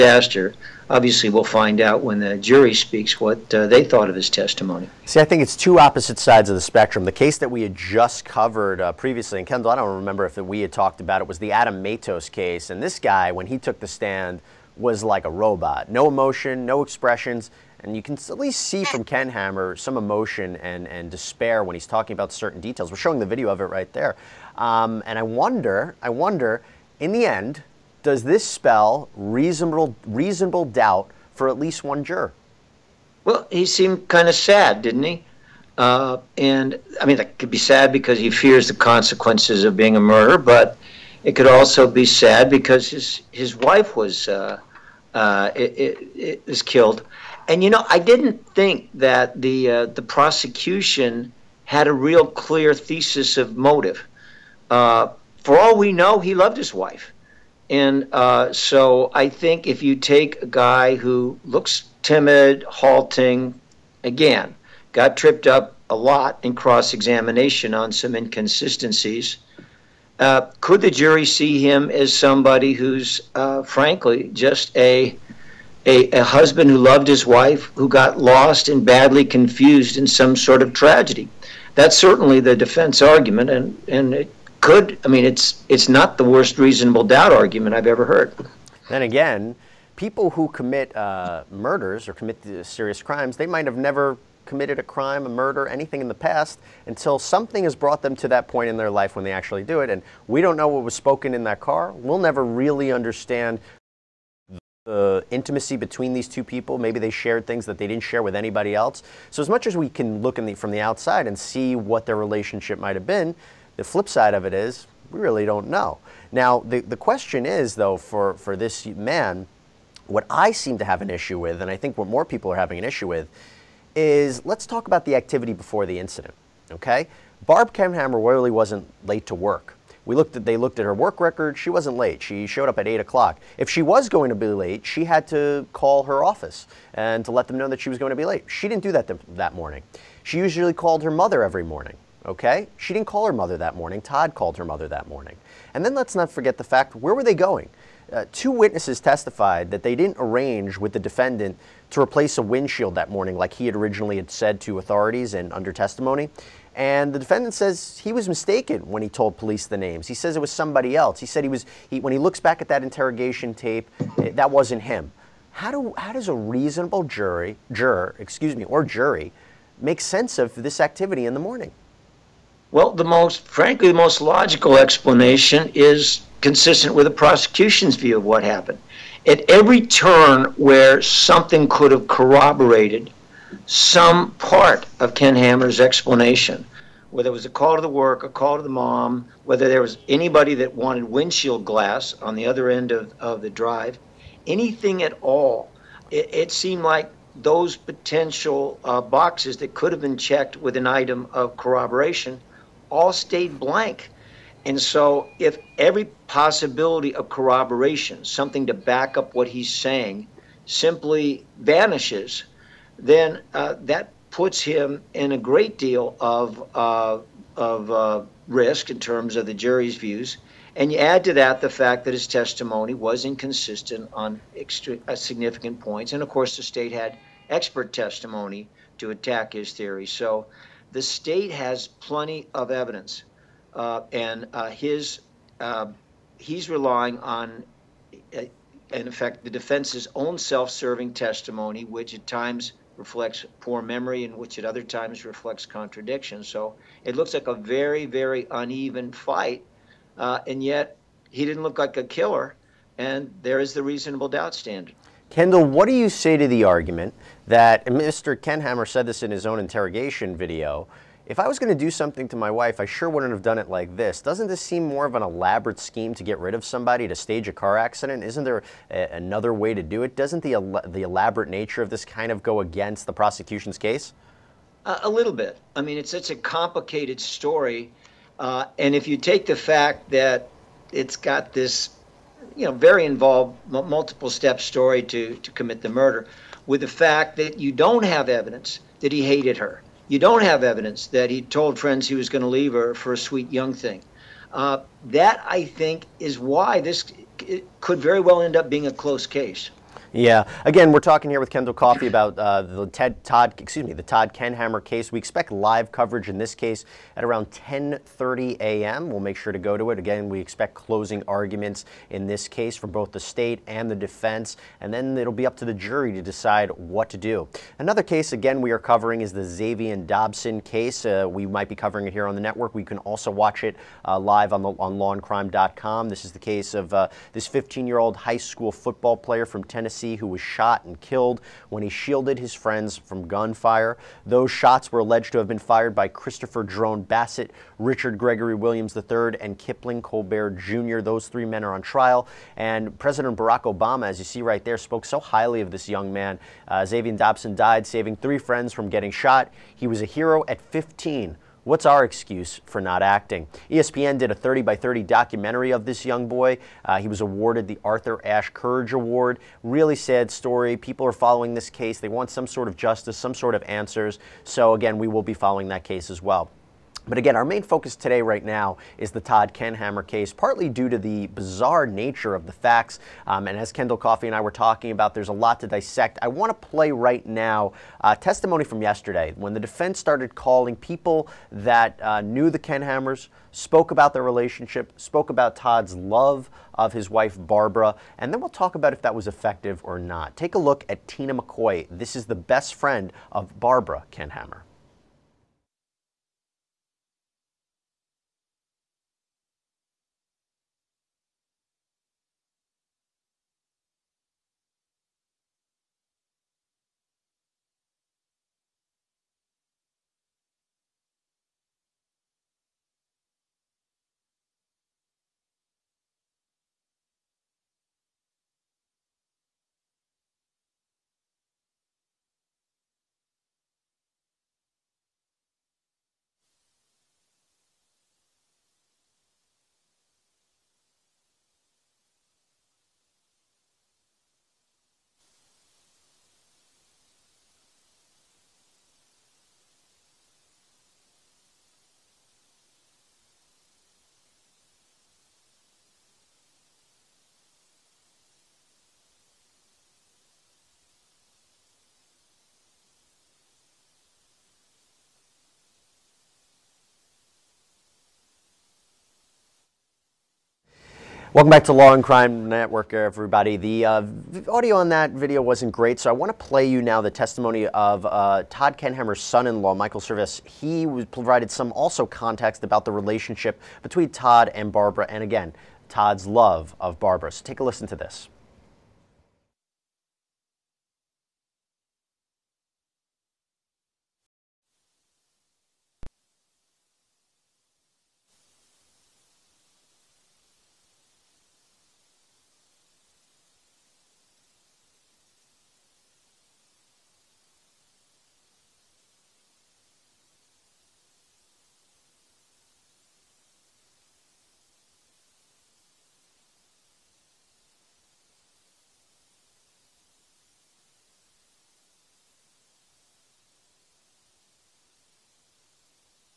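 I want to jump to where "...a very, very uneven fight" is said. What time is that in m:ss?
4:07.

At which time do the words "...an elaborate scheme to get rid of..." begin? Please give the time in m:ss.
4:25.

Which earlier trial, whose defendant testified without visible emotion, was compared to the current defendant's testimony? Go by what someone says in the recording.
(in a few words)
Adam Matos case.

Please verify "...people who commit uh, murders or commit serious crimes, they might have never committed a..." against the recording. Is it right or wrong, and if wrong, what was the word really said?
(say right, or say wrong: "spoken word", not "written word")
right.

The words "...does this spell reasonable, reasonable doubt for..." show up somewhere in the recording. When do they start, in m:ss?
0:28.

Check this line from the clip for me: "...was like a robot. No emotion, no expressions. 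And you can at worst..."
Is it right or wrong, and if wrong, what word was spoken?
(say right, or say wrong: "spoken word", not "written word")
wrong: "least", not "worst".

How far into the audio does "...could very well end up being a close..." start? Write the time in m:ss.
4:57.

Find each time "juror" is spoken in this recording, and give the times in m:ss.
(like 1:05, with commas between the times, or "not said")
0:32, 2:47.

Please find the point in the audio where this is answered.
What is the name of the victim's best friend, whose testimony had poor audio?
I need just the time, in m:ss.
6:31.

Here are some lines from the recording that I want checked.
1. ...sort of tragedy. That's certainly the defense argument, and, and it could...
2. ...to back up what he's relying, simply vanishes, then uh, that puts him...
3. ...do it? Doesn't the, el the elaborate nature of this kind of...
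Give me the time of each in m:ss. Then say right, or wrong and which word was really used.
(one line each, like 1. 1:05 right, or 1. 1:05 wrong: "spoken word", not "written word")
1. 1:20 right
2. 3:28 wrong: "saying", not "relying"
3. 4:29 right.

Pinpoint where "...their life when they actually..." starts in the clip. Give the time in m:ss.
1:38.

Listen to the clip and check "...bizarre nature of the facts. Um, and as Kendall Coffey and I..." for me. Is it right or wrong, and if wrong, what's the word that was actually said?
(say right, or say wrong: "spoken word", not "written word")
right.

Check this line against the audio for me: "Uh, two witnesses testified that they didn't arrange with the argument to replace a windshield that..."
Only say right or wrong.
wrong.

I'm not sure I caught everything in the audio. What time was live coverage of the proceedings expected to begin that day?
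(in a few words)
10:30 a.m.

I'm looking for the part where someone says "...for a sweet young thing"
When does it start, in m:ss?
4:52.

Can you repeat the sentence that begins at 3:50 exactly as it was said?
So the state has plenty of evidence.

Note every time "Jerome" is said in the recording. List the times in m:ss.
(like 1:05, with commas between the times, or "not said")
5:36.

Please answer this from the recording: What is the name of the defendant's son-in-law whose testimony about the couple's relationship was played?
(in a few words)
Michael Service.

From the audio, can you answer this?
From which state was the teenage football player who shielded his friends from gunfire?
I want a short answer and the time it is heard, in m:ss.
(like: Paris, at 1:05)
Tennessee, at 5:29.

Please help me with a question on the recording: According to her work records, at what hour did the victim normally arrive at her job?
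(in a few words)
8 o'clock.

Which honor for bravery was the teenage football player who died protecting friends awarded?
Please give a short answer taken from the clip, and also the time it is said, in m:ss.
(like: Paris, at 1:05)
Arthur Ashe Courage Award, at 5:57.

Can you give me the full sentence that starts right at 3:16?
It, it seemed like those potential uh, boxes that could have been checked with an item of corroboration all stayed blank.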